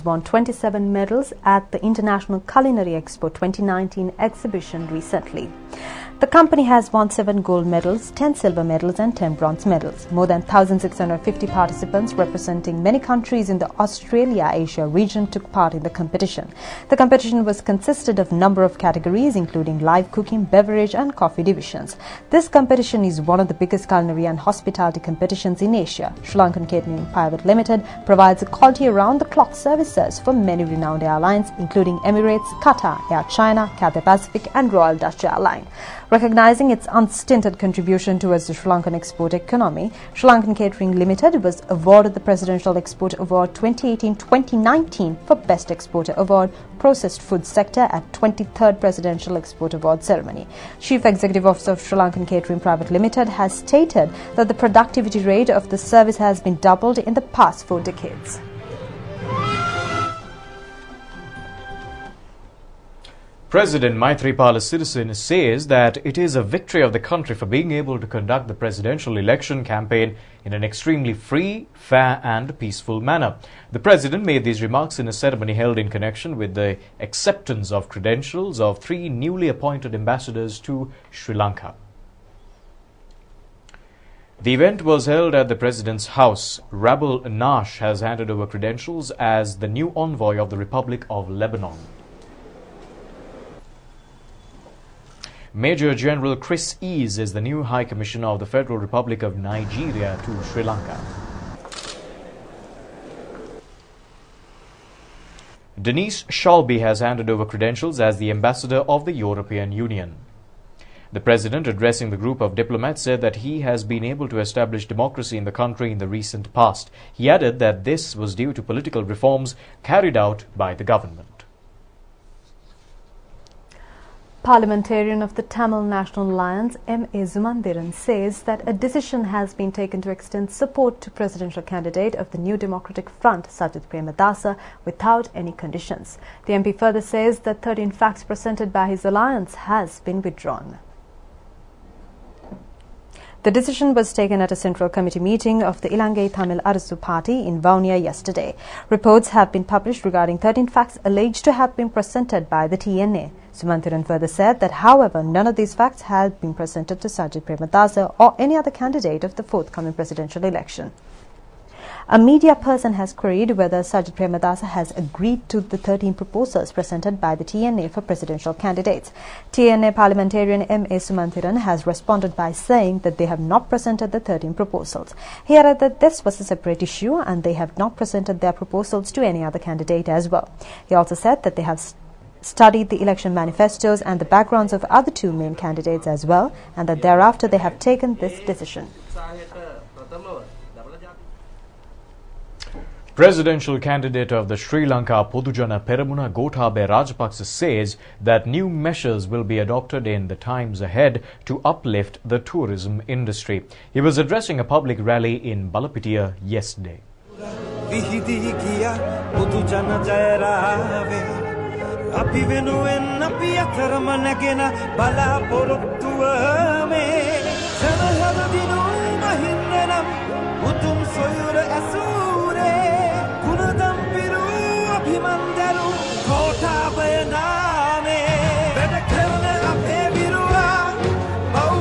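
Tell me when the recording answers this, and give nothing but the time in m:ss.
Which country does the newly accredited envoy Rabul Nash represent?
1:30.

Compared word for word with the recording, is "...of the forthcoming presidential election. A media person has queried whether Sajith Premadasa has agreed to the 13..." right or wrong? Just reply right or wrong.
right.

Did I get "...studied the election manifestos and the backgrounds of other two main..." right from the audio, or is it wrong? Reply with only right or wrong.
right.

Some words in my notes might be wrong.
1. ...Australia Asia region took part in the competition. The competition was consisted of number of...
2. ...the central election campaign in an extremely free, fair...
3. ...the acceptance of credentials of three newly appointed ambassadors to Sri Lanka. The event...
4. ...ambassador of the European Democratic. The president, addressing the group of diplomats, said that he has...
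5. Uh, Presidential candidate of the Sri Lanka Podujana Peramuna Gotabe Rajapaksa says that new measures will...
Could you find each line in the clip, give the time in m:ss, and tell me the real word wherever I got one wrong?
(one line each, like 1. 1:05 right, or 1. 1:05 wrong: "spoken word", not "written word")
1. 0:13 right
2. 1:08 wrong: "presidential", not "central"
3. 1:16 right
4. 1:48 wrong: "Union", not "Democratic"
5. 3:09 right.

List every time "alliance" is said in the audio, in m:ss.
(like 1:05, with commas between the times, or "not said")
2:06, 2:19.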